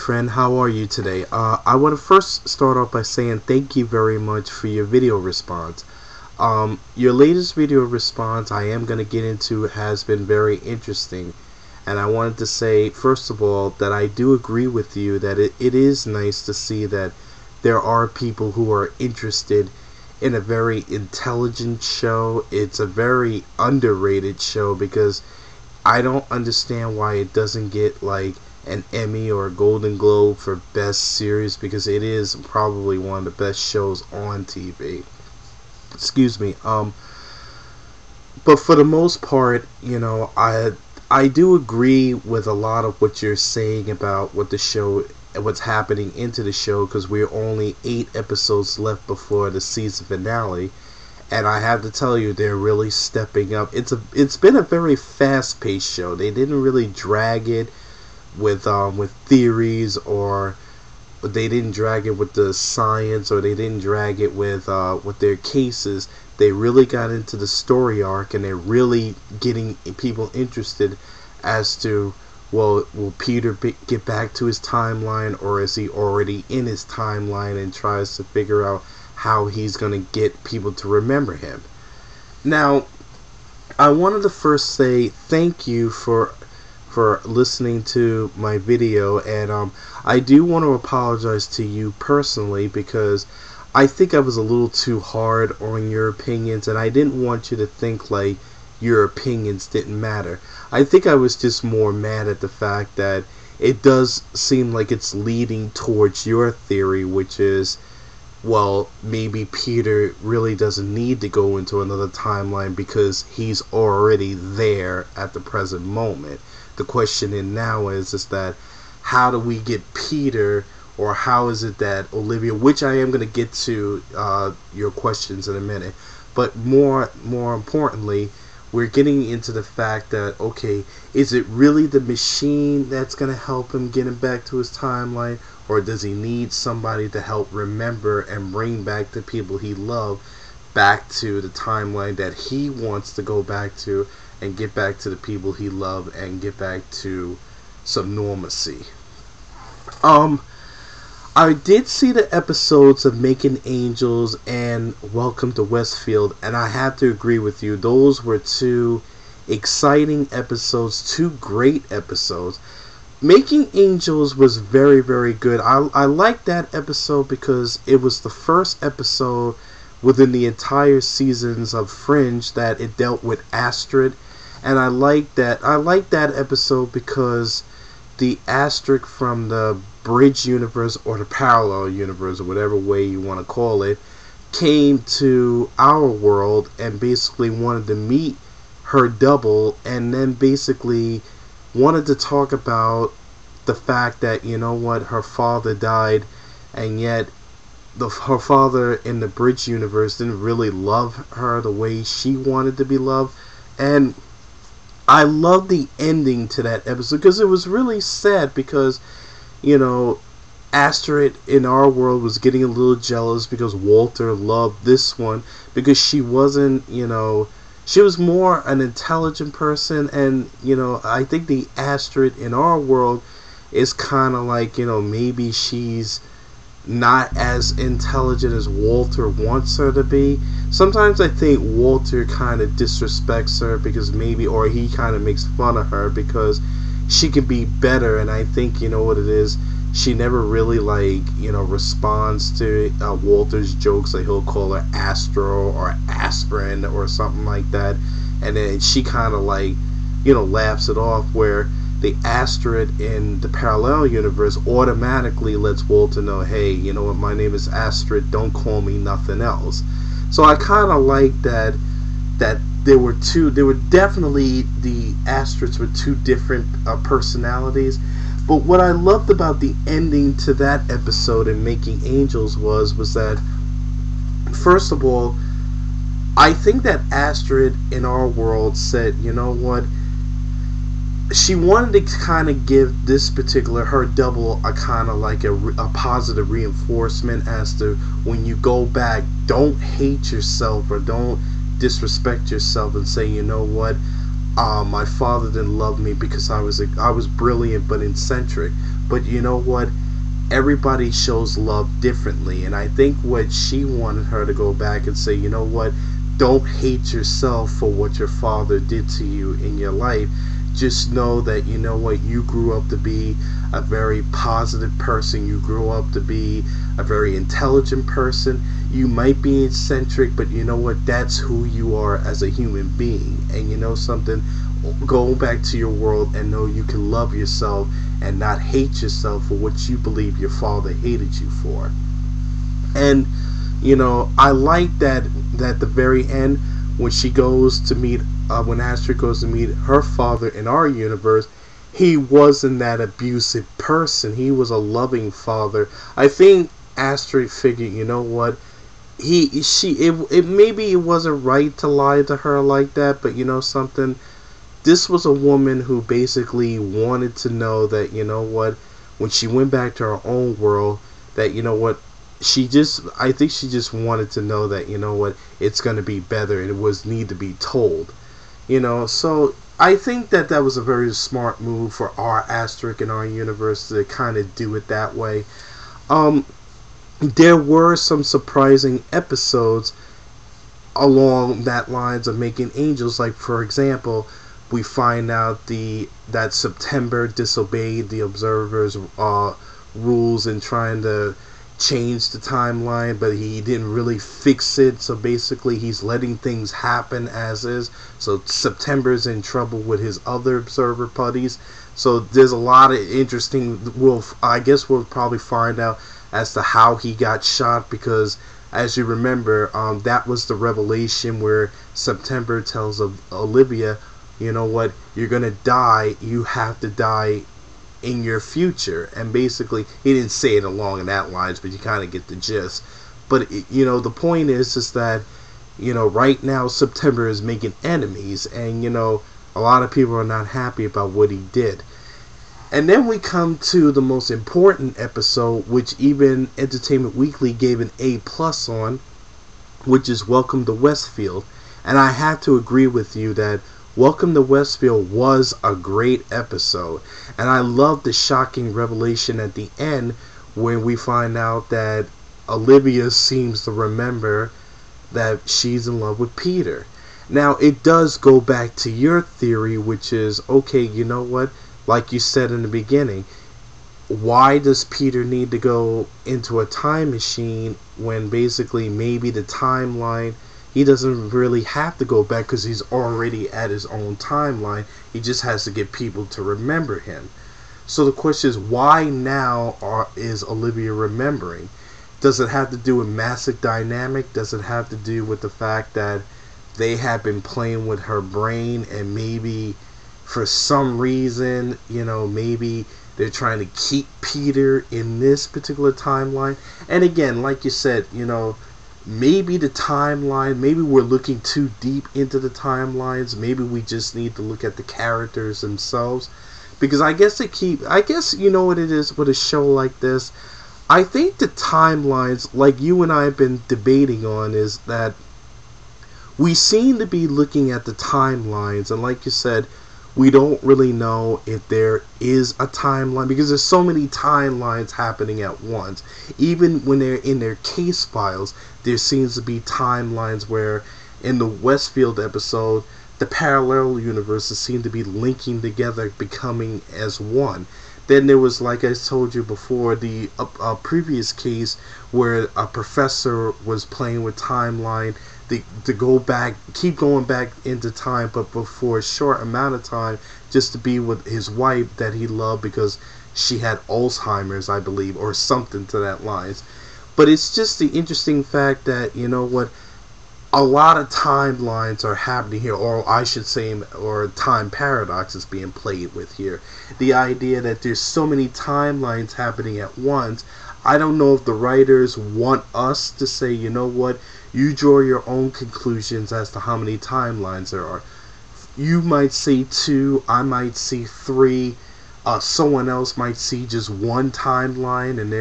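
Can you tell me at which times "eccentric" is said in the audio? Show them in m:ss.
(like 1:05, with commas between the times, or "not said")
4:58, 5:19.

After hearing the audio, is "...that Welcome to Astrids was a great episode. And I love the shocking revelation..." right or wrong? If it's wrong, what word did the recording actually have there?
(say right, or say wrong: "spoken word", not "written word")
wrong: "Westfield", not "Astrids".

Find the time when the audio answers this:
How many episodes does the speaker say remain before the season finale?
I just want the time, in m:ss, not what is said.
0:47.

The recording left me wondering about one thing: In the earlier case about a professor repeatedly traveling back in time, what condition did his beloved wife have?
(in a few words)
Alzheimer's.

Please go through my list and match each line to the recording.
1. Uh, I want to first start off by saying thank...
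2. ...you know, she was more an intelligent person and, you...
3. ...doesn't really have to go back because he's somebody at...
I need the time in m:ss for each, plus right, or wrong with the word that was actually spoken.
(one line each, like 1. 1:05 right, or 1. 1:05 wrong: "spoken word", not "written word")
1. 0:01 right
2. 3:36 right
3. 7:50 wrong: "already", not "somebody".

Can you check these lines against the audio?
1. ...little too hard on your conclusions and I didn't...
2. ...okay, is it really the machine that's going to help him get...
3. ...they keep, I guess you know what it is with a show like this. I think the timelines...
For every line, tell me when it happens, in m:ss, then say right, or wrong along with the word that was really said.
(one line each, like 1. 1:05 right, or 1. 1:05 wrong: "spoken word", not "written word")
1. 1:34 wrong: "opinions", not "conclusions"
2. 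2:10 right
3. 8:27 right.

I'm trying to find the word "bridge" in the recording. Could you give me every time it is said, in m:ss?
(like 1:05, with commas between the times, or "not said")
3:00, 3:19.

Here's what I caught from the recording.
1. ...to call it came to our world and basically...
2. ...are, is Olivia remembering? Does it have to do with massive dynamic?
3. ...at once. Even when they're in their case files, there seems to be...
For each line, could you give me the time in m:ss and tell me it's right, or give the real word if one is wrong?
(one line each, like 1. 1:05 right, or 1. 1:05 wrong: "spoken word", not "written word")
1. 3:03 right
2. 7:59 right
3. 8:45 right.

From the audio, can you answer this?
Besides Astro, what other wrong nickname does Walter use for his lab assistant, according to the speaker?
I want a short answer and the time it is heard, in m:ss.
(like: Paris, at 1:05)
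Aspirin, at 4:06.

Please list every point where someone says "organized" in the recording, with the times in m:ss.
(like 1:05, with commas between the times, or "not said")
not said.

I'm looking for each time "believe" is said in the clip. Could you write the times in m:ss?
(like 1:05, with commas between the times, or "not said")
5:29, 9:14.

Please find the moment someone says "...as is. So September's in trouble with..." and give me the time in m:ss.
6:37.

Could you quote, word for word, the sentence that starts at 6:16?
Um, there were some surprising episodes along that lines of making angels.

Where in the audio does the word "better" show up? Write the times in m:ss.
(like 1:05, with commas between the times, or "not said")
3:57, 6:06.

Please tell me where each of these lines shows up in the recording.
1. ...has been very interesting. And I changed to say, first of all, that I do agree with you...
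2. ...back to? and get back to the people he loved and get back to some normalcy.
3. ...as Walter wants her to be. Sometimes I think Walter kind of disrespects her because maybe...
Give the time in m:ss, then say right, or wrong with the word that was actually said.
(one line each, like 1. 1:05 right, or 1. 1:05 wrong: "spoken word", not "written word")
1. 0:09 wrong: "wanted", not "changed"
2. 2:23 right
3. 3:48 right.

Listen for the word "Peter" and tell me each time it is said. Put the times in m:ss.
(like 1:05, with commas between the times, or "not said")
1:13, 1:49, 1:59, 7:36, 7:44, 8:14.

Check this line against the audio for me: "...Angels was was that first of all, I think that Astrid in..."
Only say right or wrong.
right.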